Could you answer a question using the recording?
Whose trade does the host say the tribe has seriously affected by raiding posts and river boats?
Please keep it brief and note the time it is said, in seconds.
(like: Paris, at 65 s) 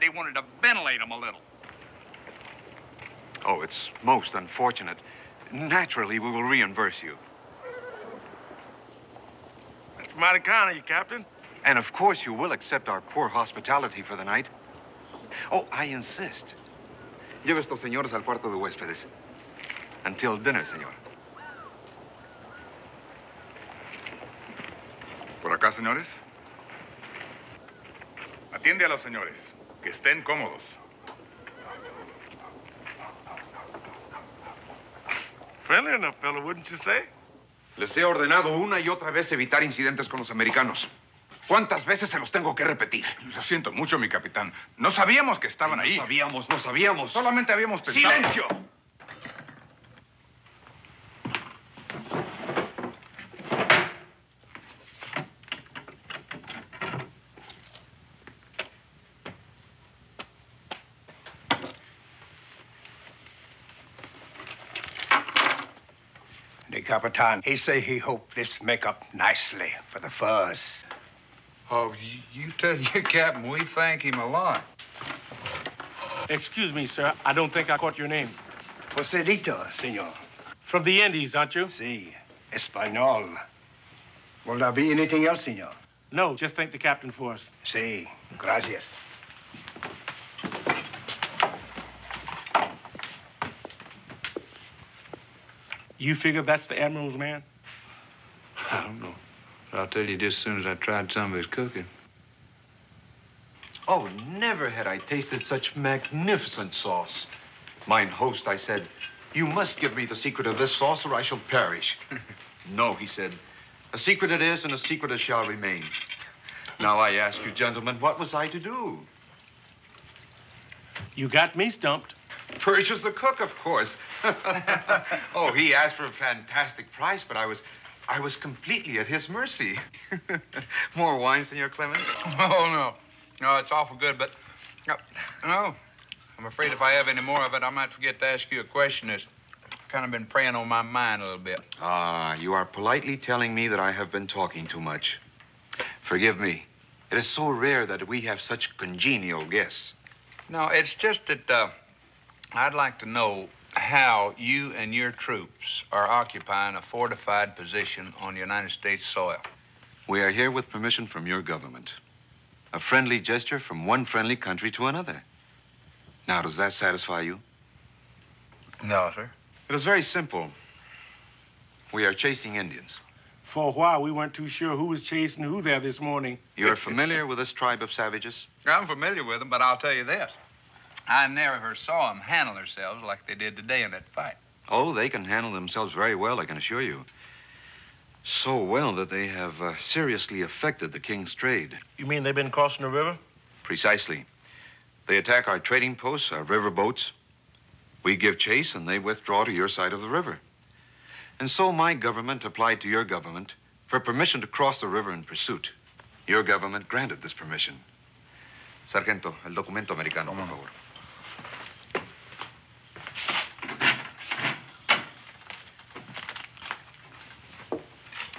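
The king's, at 190 s.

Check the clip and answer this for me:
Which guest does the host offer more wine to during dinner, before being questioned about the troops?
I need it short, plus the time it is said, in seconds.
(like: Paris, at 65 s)
Senor Clements, at 131 s.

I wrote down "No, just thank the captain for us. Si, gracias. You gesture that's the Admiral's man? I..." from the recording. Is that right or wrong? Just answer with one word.
wrong.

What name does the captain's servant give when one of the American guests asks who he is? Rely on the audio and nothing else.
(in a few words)
Joselito.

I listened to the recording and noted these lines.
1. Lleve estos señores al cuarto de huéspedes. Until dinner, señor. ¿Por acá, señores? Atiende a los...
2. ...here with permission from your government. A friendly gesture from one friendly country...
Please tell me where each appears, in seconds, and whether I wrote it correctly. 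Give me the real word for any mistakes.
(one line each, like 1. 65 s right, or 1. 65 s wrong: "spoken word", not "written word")
1. 17 s right
2. 160 s right.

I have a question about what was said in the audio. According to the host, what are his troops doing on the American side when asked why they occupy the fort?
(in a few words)
Chasing Indians.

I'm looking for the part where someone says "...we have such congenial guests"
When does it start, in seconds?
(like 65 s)
148 s.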